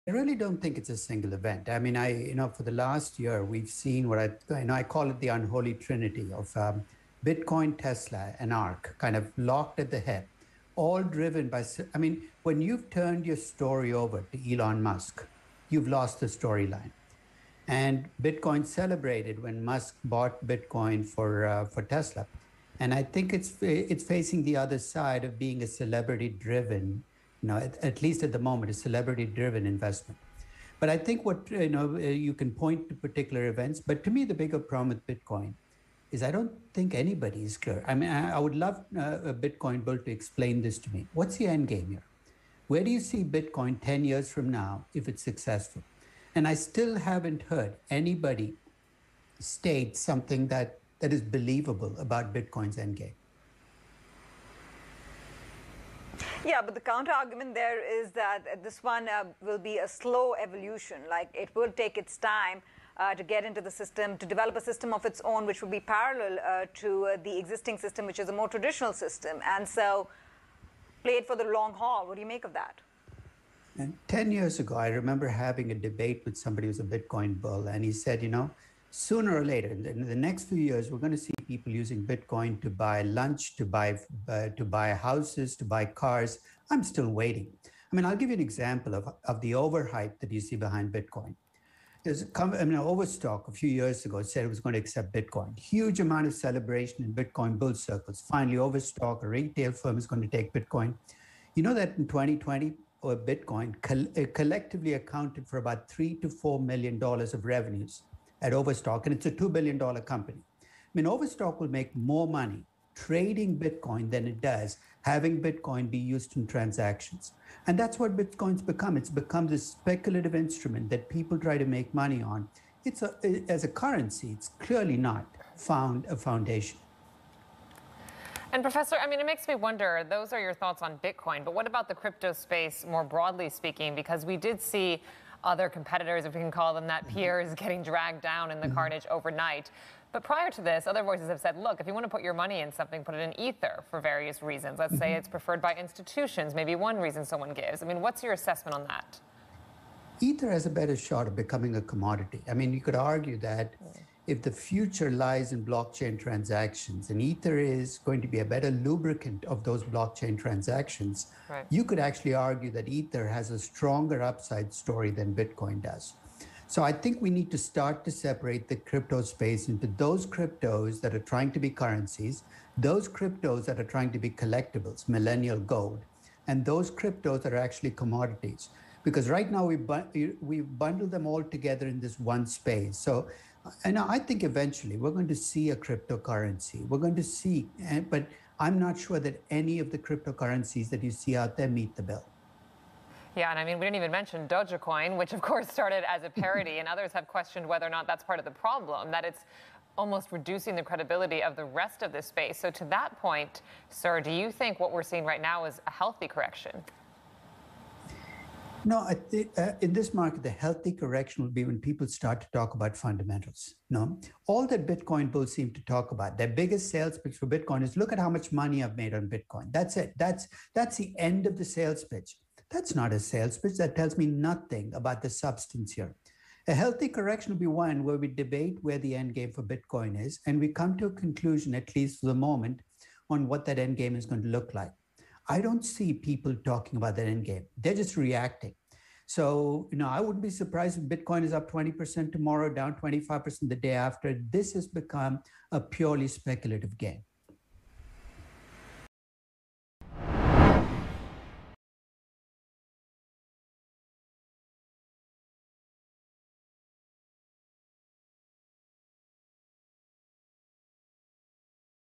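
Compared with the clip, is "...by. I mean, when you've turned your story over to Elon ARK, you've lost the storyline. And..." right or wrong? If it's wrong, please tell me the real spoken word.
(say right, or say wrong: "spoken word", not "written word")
wrong: "Musk", not "ARK".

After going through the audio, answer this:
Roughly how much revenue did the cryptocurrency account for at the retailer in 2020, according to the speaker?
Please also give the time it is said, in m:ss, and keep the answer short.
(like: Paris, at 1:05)
3 to 4 million dollars, at 1:45.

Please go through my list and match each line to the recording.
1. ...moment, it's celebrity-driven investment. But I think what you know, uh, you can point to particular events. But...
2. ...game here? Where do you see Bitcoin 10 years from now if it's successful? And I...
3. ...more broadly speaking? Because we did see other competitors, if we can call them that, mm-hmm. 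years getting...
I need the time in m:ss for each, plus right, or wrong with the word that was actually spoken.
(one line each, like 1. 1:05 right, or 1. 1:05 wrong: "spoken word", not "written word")
1. 0:28 right
2. 0:41 right
3. 2:12 wrong: "peers", not "years".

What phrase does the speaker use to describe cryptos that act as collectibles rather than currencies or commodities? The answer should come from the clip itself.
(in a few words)
millennial gold.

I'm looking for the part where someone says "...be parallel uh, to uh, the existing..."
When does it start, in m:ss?
1:05.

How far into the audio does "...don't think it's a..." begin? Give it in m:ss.
0:00.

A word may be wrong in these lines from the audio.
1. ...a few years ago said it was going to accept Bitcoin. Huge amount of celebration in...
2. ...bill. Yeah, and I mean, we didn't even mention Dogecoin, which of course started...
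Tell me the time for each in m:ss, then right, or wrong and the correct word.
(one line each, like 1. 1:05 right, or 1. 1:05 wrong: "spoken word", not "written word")
1. 1:33 right
2. 3:12 right.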